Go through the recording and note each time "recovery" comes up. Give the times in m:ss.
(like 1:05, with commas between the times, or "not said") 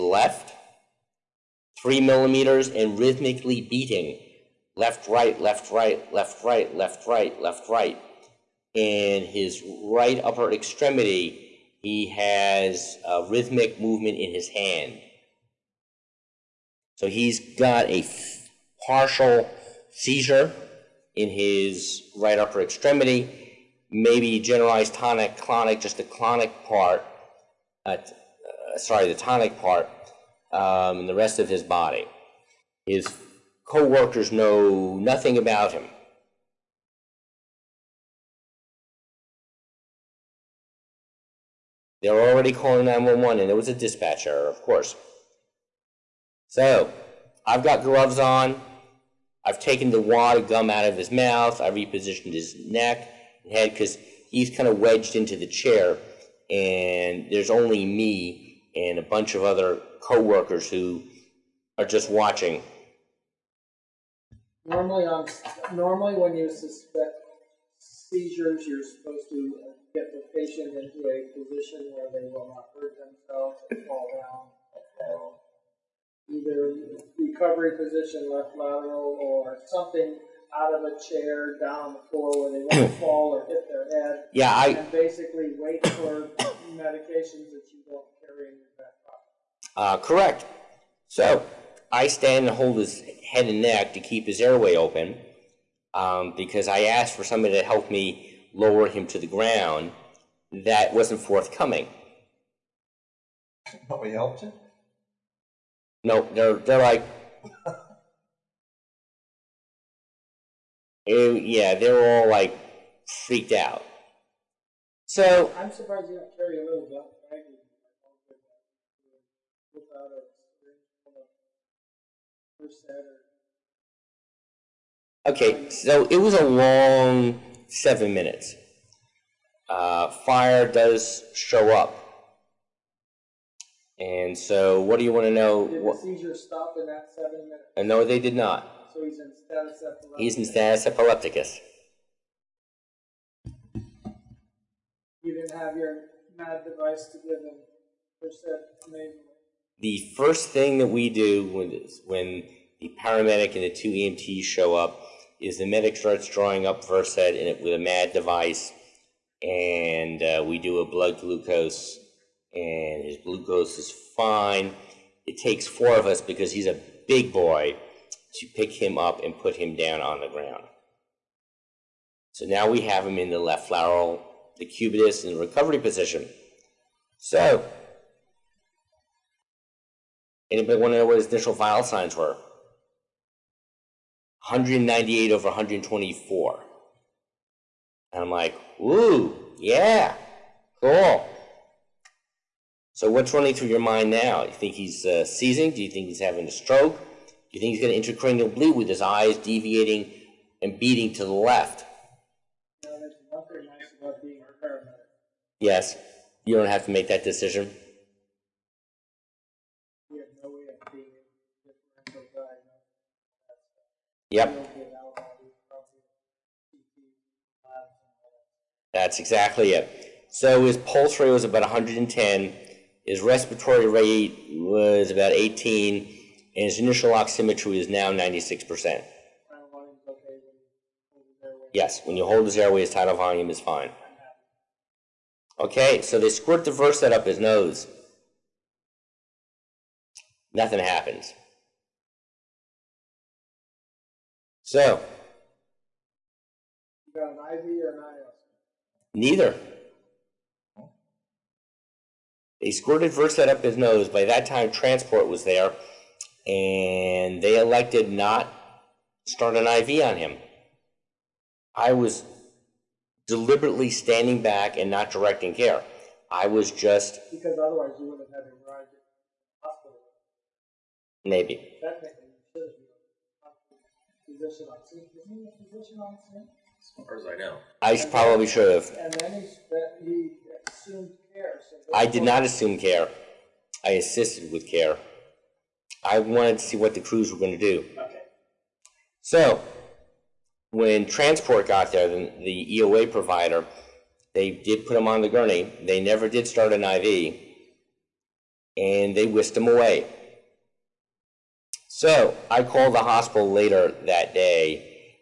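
1:17, 2:55.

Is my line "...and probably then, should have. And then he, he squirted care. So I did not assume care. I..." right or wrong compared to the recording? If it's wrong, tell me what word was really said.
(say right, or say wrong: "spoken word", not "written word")
wrong: "assumed", not "squirted".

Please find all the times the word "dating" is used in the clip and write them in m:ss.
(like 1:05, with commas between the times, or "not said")
not said.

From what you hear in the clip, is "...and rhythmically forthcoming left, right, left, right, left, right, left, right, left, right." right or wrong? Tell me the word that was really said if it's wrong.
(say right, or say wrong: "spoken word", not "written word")
wrong: "beating", not "forthcoming".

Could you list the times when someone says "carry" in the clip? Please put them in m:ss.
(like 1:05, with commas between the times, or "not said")
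1:28, 1:56.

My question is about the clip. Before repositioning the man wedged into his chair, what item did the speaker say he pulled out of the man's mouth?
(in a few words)
Gum.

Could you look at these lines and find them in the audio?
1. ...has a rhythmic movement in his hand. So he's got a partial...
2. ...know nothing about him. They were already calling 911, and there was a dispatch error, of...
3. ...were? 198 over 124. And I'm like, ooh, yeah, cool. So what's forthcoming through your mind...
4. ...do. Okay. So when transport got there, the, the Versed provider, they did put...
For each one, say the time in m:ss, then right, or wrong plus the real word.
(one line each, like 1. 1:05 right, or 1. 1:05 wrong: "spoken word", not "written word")
1. 0:12 right
2. 0:34 right
3. 3:02 wrong: "running", not "forthcoming"
4. 4:47 wrong: "EOA", not "Versed".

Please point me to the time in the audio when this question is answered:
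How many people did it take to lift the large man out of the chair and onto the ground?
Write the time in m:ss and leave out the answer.
2:45.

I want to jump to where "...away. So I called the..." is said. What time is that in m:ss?
4:59.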